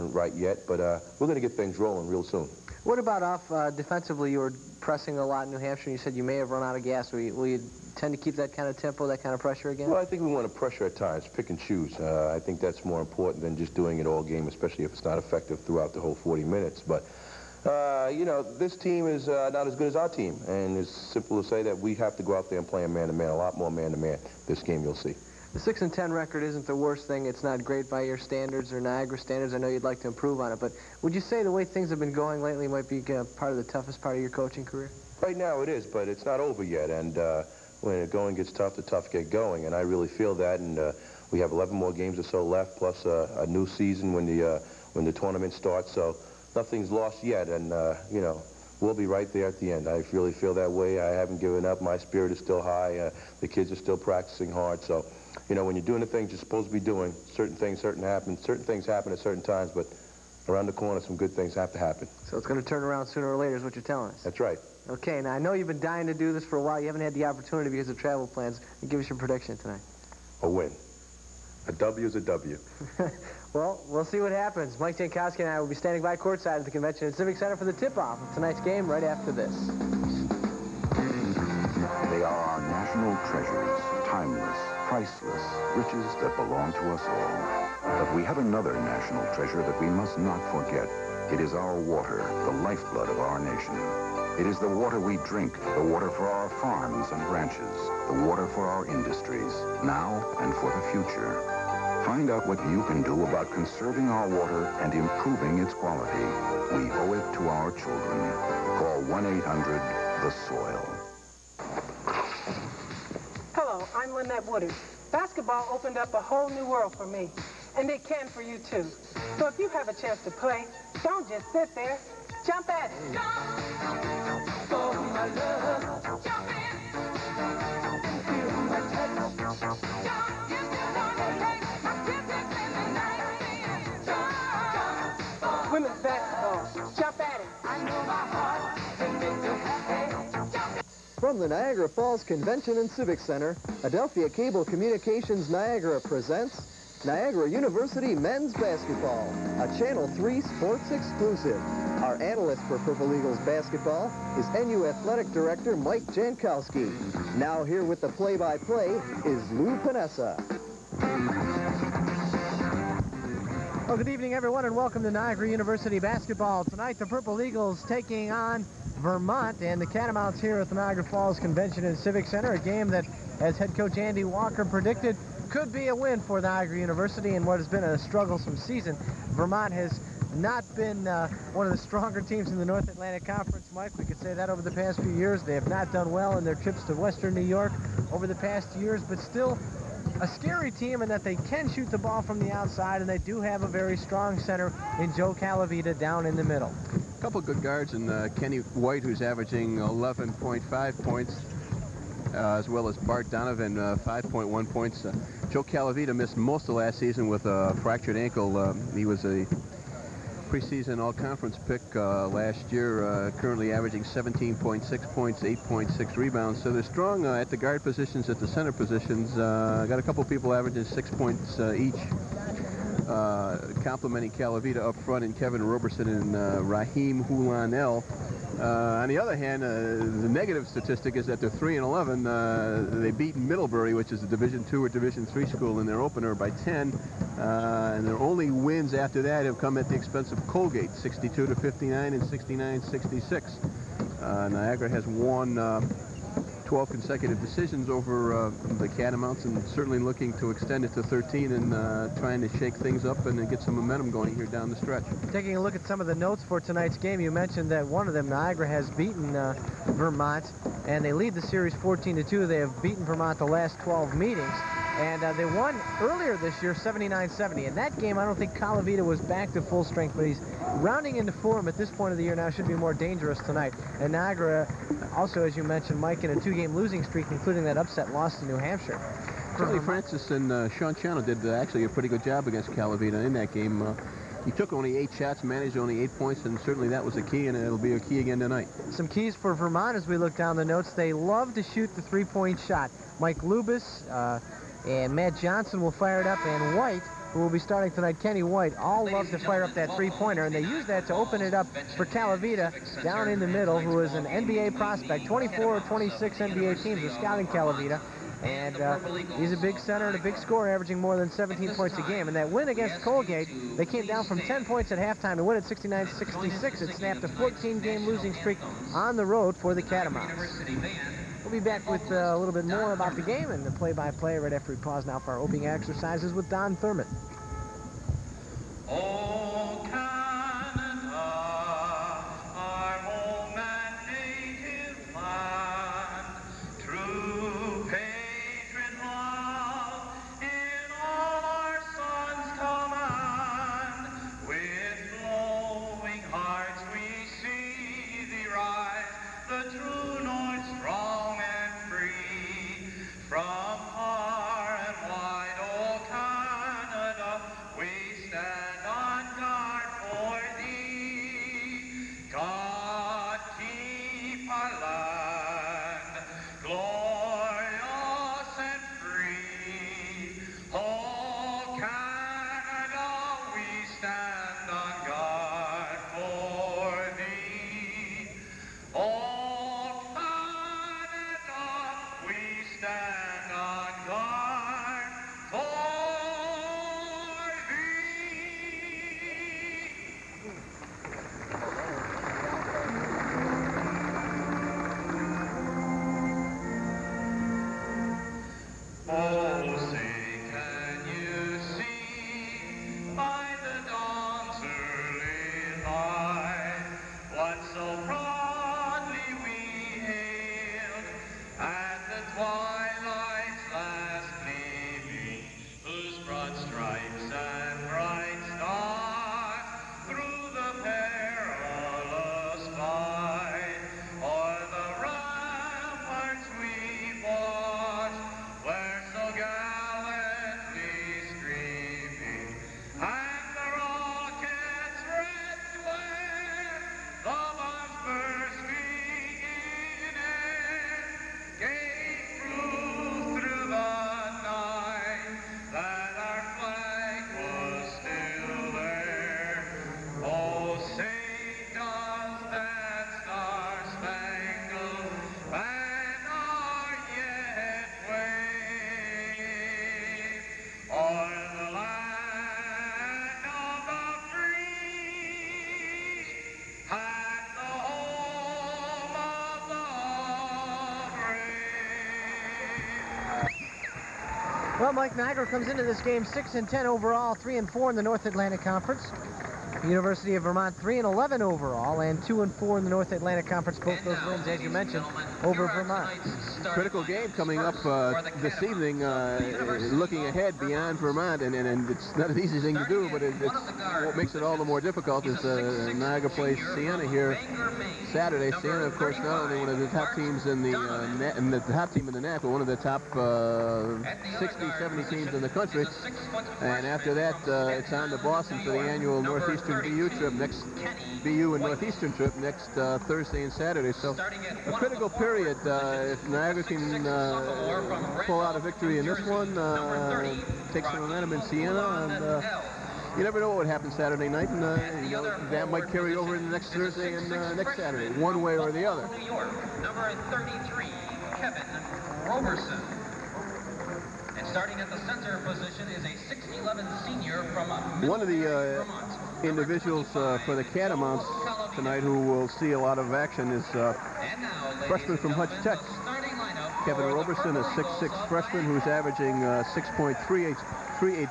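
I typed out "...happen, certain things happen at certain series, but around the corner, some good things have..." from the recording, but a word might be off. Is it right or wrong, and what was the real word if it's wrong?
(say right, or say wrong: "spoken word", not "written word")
wrong: "times", not "series".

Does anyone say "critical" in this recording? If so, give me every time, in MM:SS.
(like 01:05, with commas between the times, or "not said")
08:06, 08:34.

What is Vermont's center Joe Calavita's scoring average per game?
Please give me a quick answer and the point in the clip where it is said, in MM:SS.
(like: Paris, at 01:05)
17.6 points, at 03:34.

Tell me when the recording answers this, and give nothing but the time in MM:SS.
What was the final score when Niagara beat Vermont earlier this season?
04:26.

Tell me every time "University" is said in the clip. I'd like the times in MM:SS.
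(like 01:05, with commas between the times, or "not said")
02:27, 02:45, 02:56, 07:59.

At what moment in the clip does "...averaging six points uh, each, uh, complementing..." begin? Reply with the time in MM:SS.
03:40.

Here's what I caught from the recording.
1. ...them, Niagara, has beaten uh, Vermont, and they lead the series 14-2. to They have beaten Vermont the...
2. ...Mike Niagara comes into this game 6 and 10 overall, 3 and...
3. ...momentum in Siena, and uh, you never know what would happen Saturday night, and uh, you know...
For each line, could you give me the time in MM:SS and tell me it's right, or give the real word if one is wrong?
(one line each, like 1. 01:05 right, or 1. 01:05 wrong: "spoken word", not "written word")
1. 04:18 right
2. 07:54 right
3. 08:41 right.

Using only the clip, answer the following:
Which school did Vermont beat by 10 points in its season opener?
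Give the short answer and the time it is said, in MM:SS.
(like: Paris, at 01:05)
Middlebury, at 03:53.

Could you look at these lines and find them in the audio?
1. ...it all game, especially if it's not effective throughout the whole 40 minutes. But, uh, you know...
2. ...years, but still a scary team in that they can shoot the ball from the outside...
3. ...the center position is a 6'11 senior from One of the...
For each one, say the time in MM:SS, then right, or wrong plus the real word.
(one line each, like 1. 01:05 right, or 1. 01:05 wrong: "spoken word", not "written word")
1. 00:14 right
2. 03:08 right
3. 08:54 right.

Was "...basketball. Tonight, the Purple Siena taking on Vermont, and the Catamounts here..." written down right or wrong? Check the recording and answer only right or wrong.
wrong.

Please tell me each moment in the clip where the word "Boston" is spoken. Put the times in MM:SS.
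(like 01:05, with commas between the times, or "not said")
08:28.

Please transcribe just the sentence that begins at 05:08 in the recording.
And uh, he's a big center and a big scorer, averaging more than 17 points a game.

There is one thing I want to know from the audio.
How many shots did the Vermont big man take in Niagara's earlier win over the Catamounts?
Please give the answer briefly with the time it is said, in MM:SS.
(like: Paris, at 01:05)
8, at 04:44.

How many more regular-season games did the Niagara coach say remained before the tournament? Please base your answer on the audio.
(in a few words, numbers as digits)
11.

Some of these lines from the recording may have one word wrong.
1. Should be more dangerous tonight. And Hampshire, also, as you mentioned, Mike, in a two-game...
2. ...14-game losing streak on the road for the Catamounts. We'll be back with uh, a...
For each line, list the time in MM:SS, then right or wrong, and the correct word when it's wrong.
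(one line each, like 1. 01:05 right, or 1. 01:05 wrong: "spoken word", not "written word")
1. 04:32 wrong: "Niagara", not "Hampshire"
2. 05:17 right.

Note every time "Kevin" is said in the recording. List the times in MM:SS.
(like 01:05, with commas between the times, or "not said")
03:45, 08:51, 09:06.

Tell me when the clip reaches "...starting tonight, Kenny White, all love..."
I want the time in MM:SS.
04:57.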